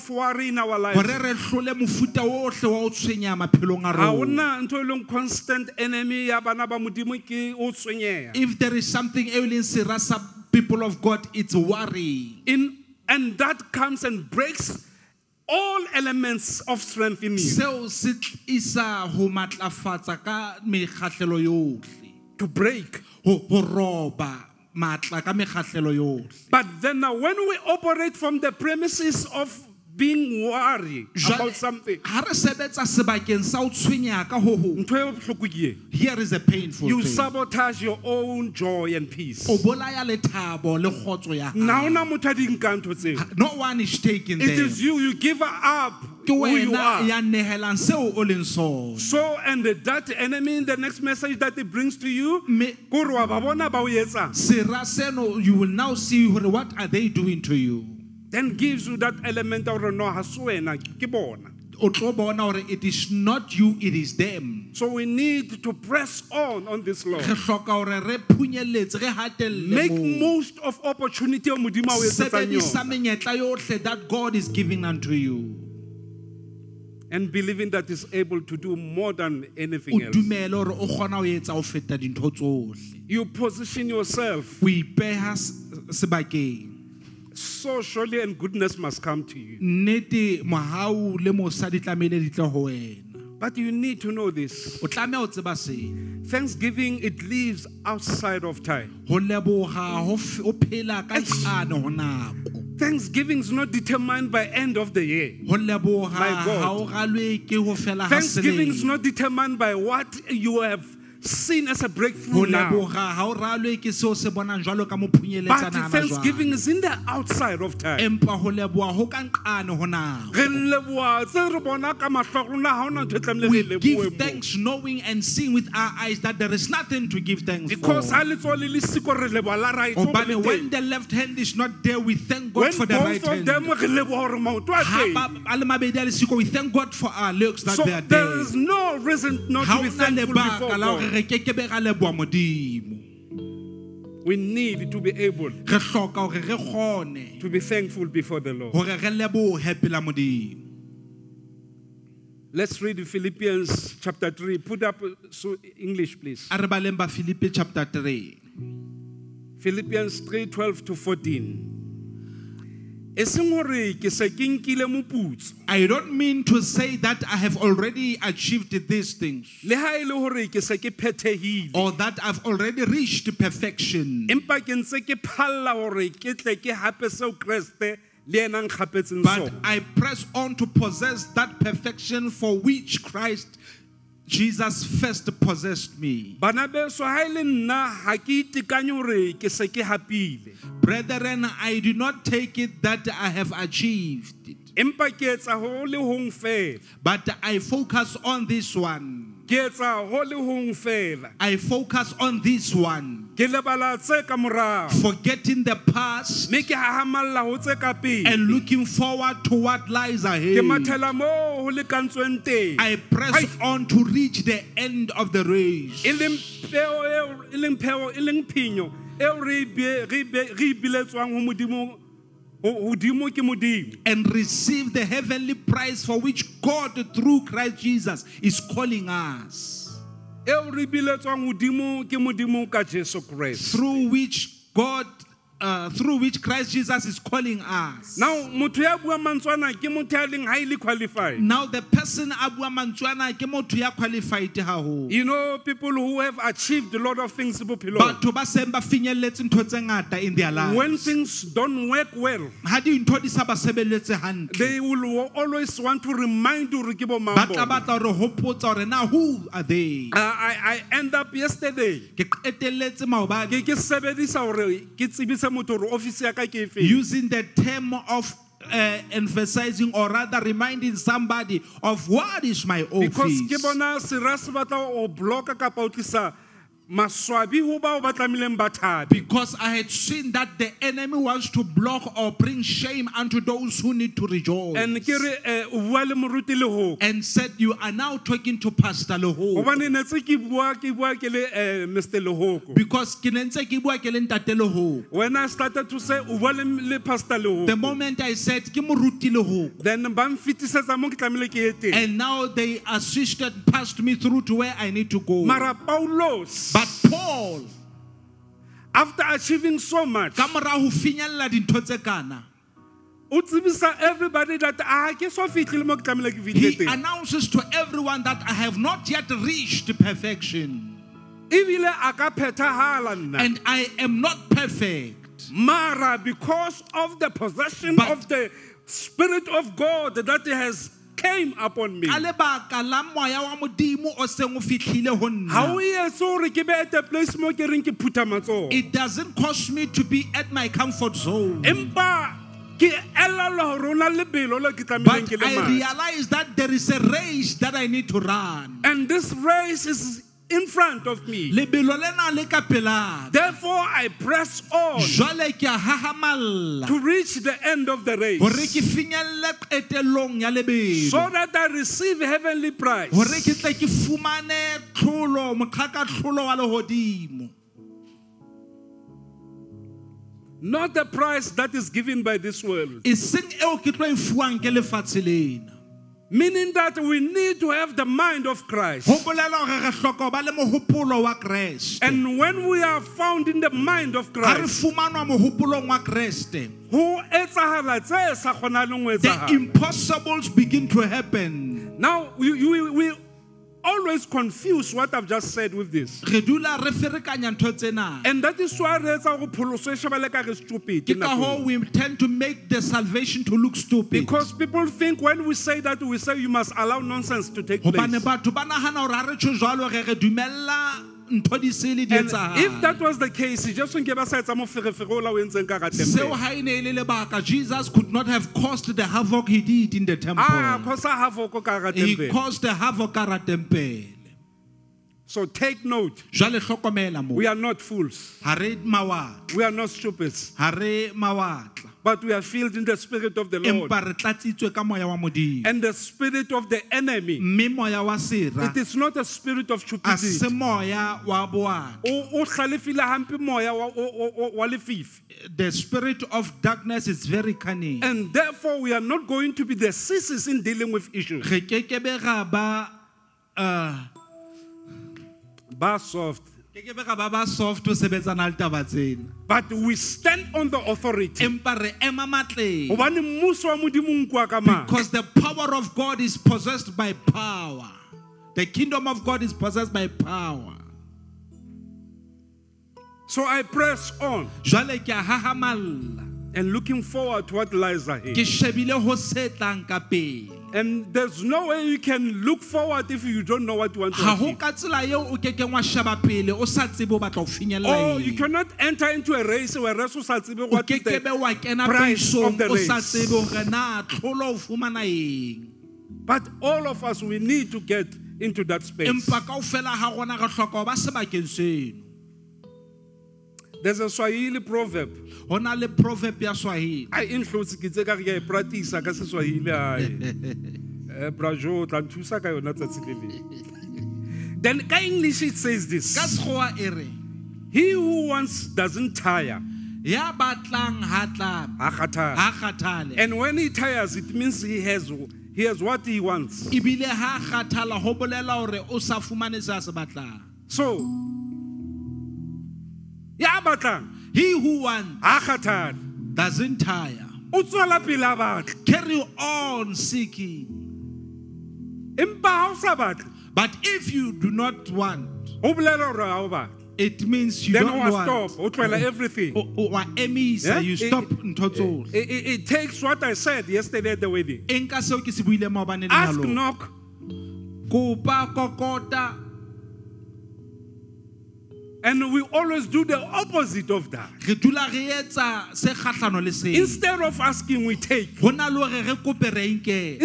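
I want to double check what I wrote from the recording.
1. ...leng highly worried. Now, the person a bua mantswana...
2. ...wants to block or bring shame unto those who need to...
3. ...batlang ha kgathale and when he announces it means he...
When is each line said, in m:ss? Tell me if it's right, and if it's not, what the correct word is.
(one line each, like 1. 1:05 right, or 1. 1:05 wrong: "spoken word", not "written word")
1. 4:00 wrong: "qualified", not "worried"
2. 4:41 right
3. 8:40 wrong: "tires", not "announces".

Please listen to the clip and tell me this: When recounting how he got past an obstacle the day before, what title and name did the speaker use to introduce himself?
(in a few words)
Pastor Lehoko.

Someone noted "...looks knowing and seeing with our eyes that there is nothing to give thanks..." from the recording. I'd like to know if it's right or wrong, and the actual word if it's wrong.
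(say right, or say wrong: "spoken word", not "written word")
wrong: "thanks", not "looks".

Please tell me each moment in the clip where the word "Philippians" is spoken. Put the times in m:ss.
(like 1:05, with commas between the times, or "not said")
2:33, 2:39.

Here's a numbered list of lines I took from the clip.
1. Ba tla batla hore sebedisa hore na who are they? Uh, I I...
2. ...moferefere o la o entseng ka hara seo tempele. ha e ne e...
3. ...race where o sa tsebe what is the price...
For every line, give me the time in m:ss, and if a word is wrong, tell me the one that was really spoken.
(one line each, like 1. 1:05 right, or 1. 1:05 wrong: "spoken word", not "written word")
1. 4:17 wrong: "hopotsa", not "sebedisa"
2. 6:54 right
3. 8:09 right.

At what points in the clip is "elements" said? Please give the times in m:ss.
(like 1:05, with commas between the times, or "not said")
0:15, 0:59.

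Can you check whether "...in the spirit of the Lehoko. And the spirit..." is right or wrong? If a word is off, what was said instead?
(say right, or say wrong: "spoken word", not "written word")
wrong: "Lord", not "Lehoko".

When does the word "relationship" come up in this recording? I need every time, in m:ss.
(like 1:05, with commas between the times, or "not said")
not said.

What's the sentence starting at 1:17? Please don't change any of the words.
And believing that is able to do more than anything else.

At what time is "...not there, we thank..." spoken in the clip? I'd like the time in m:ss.
2:11.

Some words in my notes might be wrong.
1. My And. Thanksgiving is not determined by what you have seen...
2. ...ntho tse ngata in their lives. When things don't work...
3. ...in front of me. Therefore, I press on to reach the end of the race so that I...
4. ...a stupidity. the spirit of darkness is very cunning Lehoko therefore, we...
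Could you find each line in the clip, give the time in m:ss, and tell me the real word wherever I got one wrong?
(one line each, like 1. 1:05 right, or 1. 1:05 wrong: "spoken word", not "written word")
1. 1:45 wrong: "God", not "And"
2. 4:09 right
3. 5:50 right
4. 7:19 wrong: "And", not "Lehoko".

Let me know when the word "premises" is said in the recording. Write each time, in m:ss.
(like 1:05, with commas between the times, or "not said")
0:28.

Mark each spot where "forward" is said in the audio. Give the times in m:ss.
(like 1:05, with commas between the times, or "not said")
3:28, 7:57, 8:02.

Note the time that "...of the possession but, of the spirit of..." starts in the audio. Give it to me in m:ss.
5:26.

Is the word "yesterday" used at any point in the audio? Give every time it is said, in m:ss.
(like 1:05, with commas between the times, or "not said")
4:21, 9:13.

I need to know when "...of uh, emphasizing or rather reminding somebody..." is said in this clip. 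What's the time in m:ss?
4:27.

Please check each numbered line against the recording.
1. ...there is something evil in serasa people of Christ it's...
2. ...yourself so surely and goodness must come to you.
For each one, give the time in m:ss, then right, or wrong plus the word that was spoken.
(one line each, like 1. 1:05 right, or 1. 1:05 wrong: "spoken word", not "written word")
1. 0:08 wrong: "God", not "Christ"
2. 1:23 right.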